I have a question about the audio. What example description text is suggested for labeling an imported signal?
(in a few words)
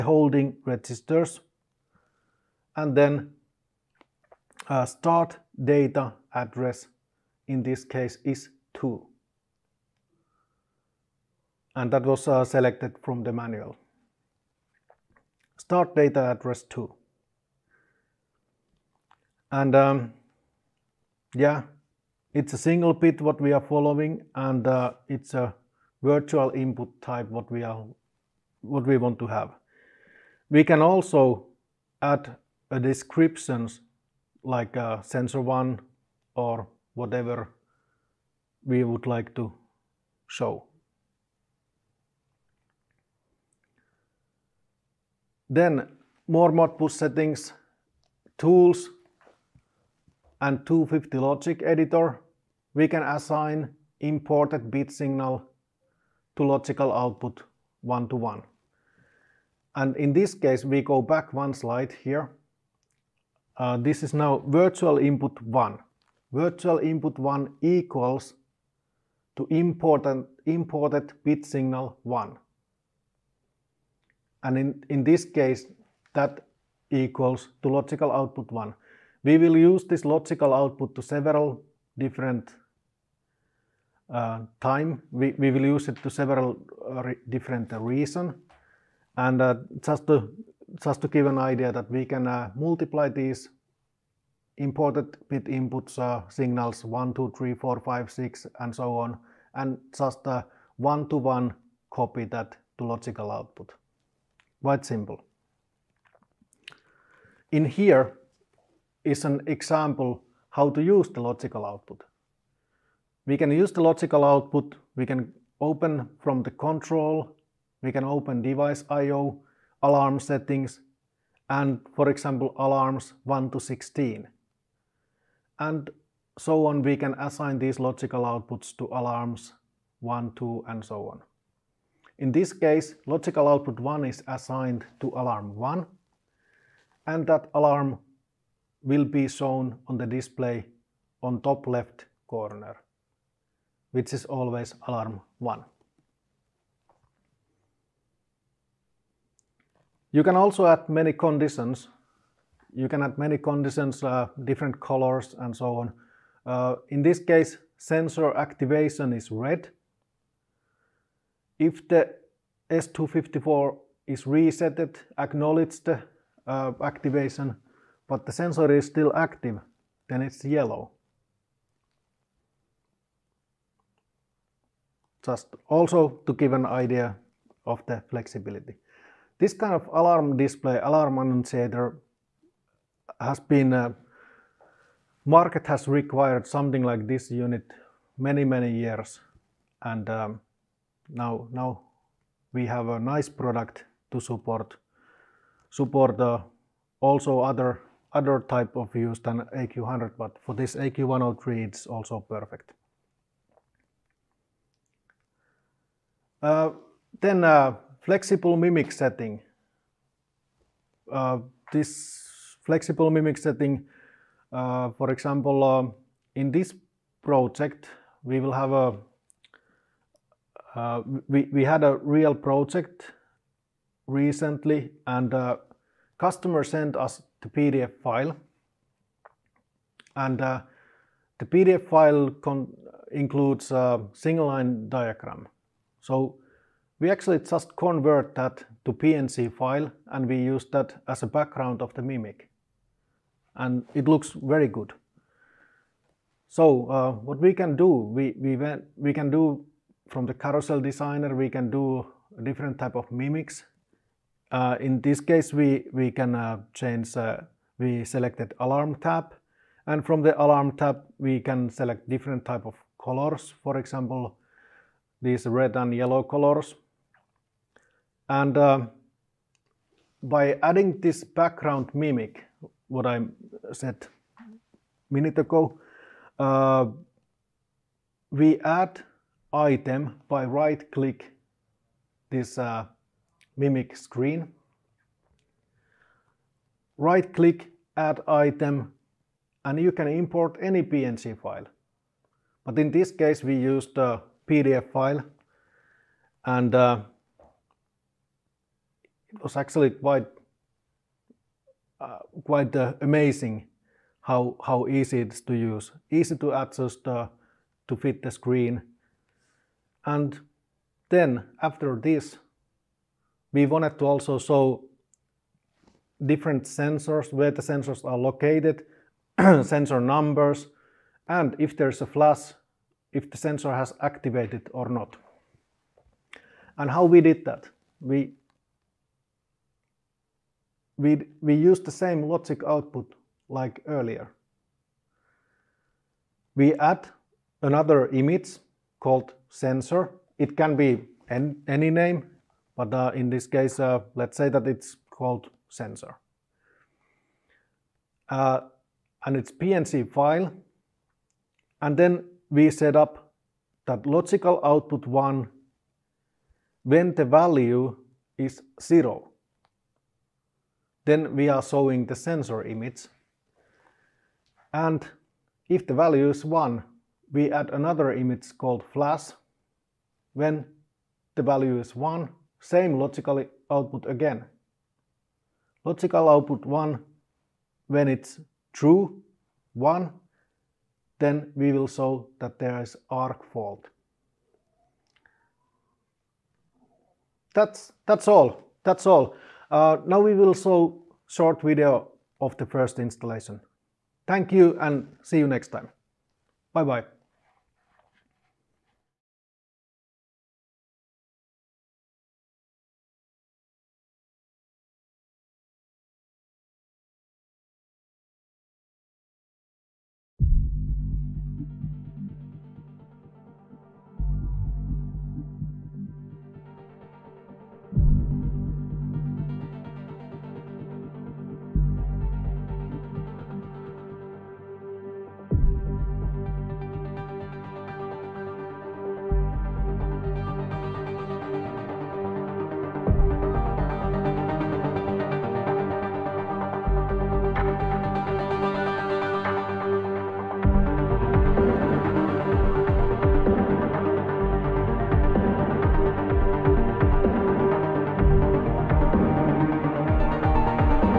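sensor 1.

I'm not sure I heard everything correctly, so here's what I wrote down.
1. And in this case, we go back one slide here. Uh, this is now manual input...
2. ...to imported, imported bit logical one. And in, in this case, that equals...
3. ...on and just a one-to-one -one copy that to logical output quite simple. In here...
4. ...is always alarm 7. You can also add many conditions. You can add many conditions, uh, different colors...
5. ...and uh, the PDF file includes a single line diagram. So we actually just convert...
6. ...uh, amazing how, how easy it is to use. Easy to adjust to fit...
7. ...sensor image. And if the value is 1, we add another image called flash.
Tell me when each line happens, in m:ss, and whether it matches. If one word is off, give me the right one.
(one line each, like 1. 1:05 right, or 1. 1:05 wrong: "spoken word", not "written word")
1. 0:59 wrong: "virtual", not "manual"
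2. 1:09 wrong: "signal", not "logical"
3. 1:38 right
4. 2:24 wrong: "1", not "7"
5. 3:50 right
6. 5:02 right
7. 6:02 right.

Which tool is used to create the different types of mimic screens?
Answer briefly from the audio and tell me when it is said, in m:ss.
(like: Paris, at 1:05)
carousel designer, at 4:10.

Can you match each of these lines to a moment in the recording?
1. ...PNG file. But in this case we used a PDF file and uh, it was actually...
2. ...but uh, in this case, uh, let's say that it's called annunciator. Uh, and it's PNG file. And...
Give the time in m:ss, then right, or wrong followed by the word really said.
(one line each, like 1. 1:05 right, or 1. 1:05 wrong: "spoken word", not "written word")
1. 4:50 right
2. 5:42 wrong: "sensor", not "annunciator".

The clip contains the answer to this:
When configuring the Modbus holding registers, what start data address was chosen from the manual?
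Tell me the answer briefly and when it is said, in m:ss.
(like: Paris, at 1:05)
2, at 0:15.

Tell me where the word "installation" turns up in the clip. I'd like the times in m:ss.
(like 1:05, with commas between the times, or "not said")
6:32.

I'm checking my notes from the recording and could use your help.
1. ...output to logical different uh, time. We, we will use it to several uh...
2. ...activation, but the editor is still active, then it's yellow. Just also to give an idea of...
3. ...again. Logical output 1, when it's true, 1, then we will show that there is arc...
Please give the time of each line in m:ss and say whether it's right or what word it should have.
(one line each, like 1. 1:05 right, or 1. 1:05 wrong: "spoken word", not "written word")
1. 1:20 wrong: "several", not "logical"
2. 2:46 wrong: "sensor", not "editor"
3. 6:14 right.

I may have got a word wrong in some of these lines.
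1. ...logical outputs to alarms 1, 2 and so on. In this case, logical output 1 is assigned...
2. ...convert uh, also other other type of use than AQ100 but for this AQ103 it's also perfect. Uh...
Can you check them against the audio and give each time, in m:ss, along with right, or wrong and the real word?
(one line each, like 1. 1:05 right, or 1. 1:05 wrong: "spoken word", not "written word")
1. 2:07 right
2. 3:15 wrong: "support", not "convert".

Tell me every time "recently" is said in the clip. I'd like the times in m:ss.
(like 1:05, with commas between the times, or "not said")
3:44.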